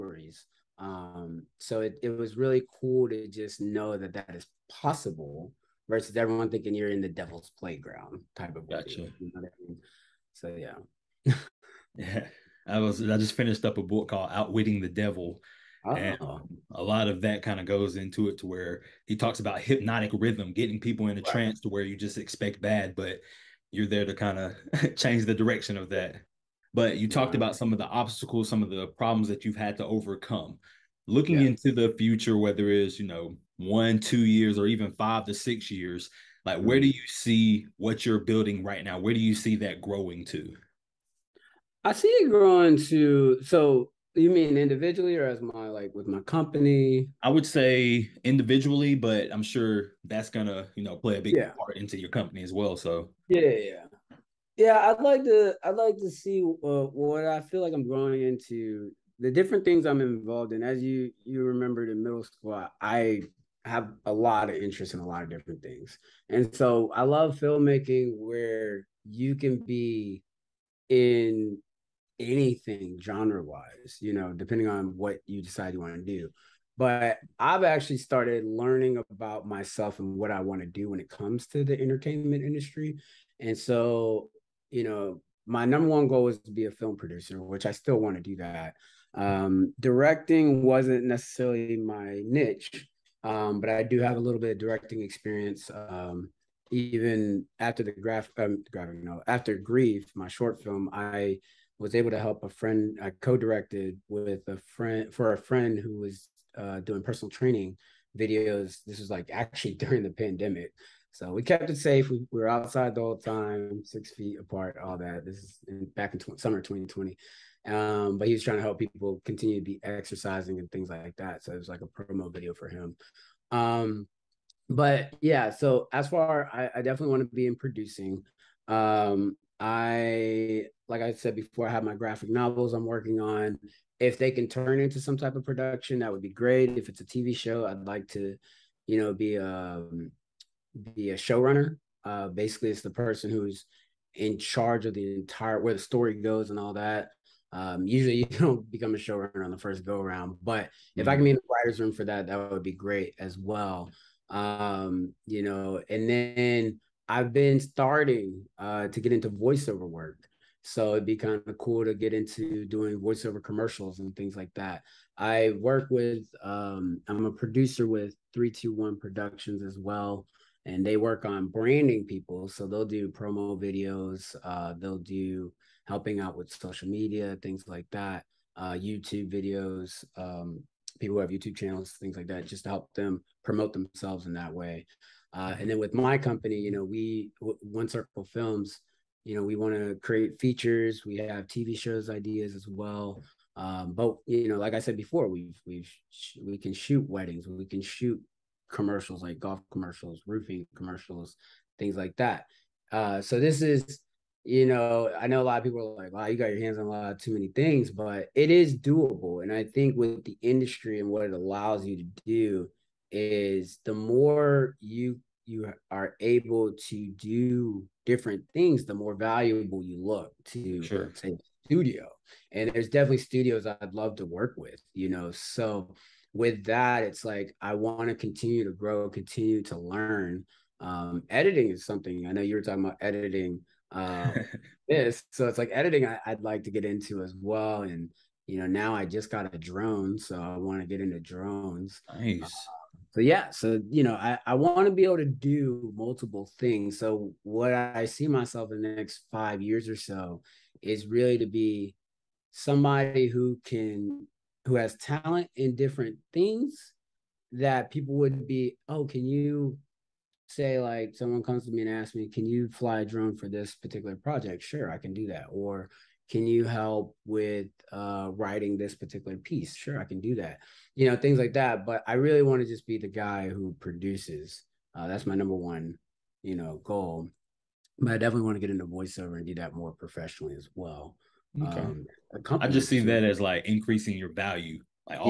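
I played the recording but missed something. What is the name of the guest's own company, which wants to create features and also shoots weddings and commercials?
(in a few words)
One Circle Films.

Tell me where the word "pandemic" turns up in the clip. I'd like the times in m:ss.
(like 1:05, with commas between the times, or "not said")
1:50.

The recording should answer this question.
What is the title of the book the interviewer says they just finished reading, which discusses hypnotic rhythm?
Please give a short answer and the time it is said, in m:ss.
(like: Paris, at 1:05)
Outwitting the Devil, at 0:14.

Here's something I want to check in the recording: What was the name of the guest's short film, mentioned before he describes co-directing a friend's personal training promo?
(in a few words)
Grief.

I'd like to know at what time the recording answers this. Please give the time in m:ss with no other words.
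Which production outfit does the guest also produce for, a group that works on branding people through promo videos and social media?
2:48.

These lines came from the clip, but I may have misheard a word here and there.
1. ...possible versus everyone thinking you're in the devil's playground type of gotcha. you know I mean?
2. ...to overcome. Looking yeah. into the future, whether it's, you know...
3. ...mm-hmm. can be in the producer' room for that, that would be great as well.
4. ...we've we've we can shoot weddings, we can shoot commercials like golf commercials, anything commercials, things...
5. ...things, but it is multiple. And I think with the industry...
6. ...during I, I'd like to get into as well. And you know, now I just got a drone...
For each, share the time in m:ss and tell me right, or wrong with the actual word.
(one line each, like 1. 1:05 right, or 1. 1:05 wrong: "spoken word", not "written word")
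1. 0:04 right
2. 0:29 right
3. 2:31 wrong: "writers", not "producer"
4. 3:15 wrong: "roofing", not "anything"
5. 3:27 wrong: "doable", not "multiple"
6. 3:55 wrong: "editing", not "during".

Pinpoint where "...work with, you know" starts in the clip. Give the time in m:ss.
3:44.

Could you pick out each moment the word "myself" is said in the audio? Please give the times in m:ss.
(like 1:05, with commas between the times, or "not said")
1:19, 4:08.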